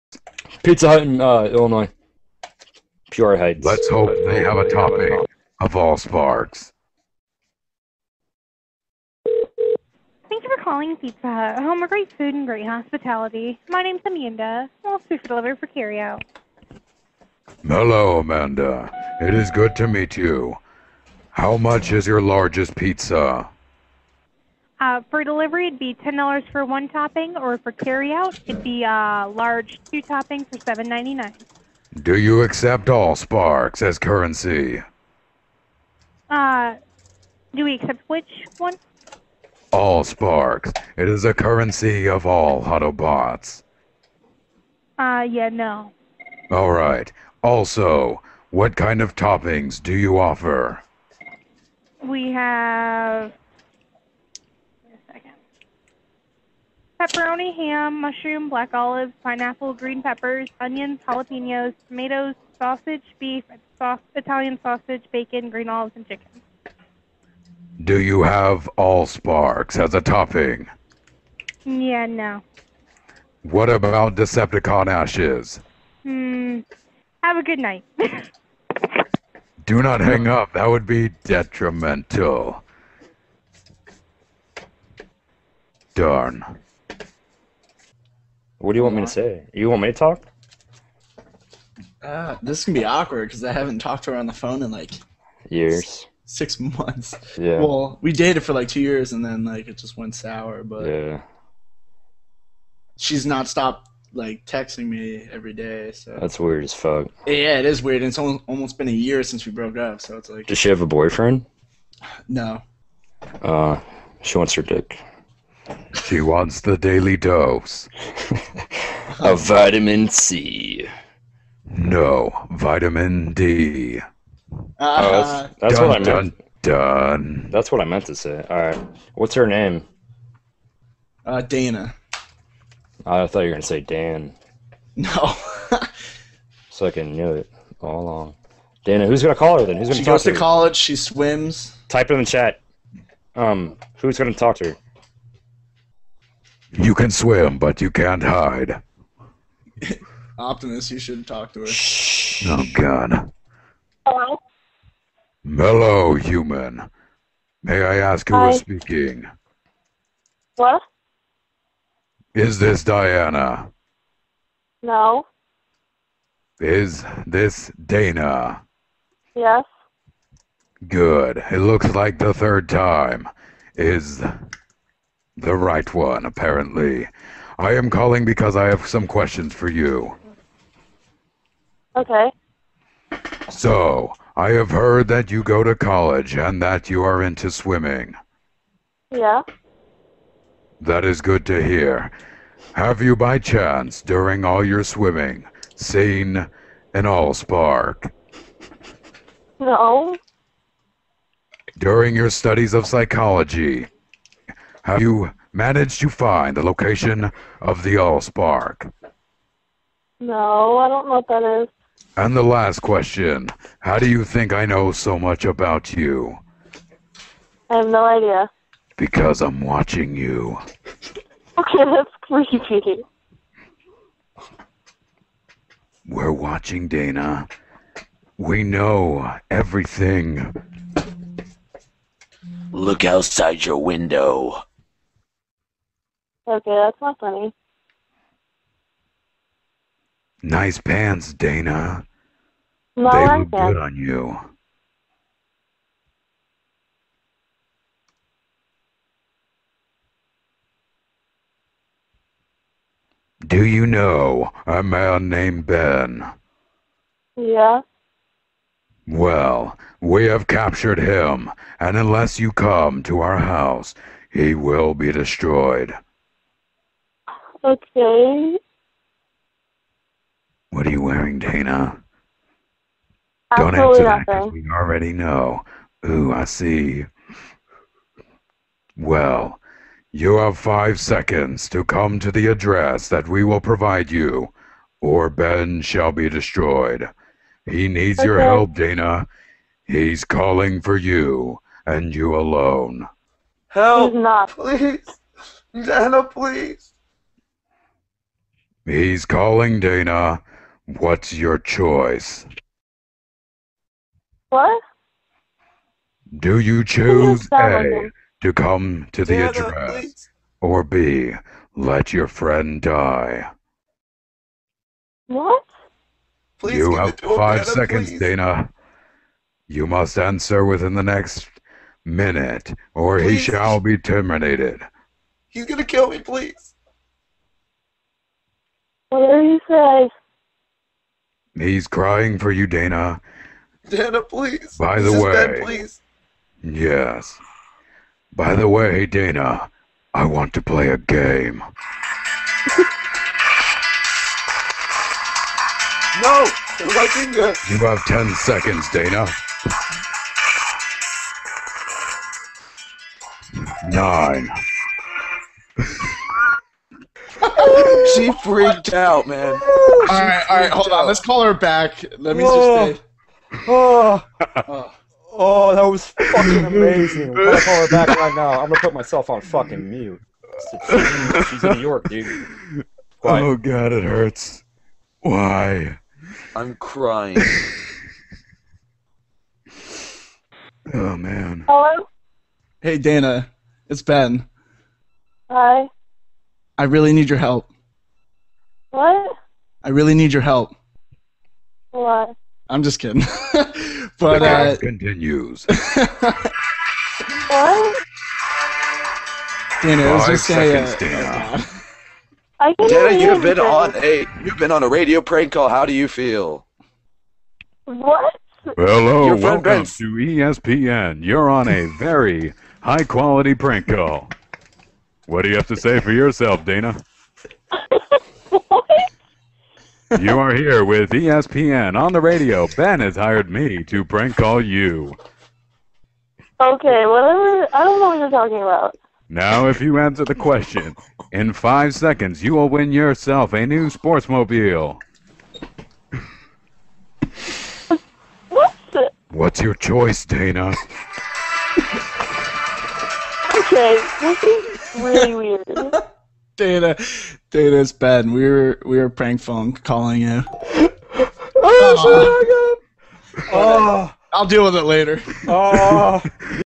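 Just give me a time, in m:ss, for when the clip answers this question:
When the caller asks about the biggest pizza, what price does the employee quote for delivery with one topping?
0:25.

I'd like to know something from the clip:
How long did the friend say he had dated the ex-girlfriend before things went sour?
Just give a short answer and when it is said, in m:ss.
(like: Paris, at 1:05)
2 years, at 1:38.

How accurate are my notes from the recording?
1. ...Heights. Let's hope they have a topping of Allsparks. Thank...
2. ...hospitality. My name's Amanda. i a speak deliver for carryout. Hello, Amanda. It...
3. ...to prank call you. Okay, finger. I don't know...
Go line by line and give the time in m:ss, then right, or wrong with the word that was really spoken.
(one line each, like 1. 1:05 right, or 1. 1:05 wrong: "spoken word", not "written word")
1. 0:03 right
2. 0:12 right
3. 7:03 wrong: "whatever", not "finger".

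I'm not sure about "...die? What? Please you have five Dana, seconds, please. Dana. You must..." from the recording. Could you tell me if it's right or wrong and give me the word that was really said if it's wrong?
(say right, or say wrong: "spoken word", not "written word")
right.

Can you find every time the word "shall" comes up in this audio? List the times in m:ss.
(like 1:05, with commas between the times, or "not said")
4:45, 5:23.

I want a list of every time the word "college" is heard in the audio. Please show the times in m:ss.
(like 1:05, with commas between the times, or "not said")
2:20, 3:05.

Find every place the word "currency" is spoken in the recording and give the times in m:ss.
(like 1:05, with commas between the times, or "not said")
0:33, 0:41.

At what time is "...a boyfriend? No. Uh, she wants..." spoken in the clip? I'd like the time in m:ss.
1:50.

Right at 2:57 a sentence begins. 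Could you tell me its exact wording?
I am calling because I have some questions for you.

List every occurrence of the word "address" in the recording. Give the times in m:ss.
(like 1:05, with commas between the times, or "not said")
4:42, 5:09.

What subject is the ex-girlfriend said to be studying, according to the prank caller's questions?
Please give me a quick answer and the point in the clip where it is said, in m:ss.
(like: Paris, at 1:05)
Psychology, at 3:22.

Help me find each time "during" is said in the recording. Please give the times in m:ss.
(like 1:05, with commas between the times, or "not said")
3:14, 3:21.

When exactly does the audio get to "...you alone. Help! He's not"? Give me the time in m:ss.
4:52.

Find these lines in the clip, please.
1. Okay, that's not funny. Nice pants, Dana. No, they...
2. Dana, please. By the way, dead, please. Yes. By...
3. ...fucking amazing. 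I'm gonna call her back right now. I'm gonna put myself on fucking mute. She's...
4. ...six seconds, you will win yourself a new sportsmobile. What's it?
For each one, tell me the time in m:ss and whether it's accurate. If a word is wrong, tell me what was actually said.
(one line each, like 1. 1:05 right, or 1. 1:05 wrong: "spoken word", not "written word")
1. 3:56 right
2. 5:33 right
3. 6:06 right
4. 7:11 wrong: "five", not "six".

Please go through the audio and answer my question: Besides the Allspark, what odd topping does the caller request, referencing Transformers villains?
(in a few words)
Decepticon ashes.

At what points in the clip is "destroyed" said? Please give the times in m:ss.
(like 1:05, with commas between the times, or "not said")
4:25, 4:46.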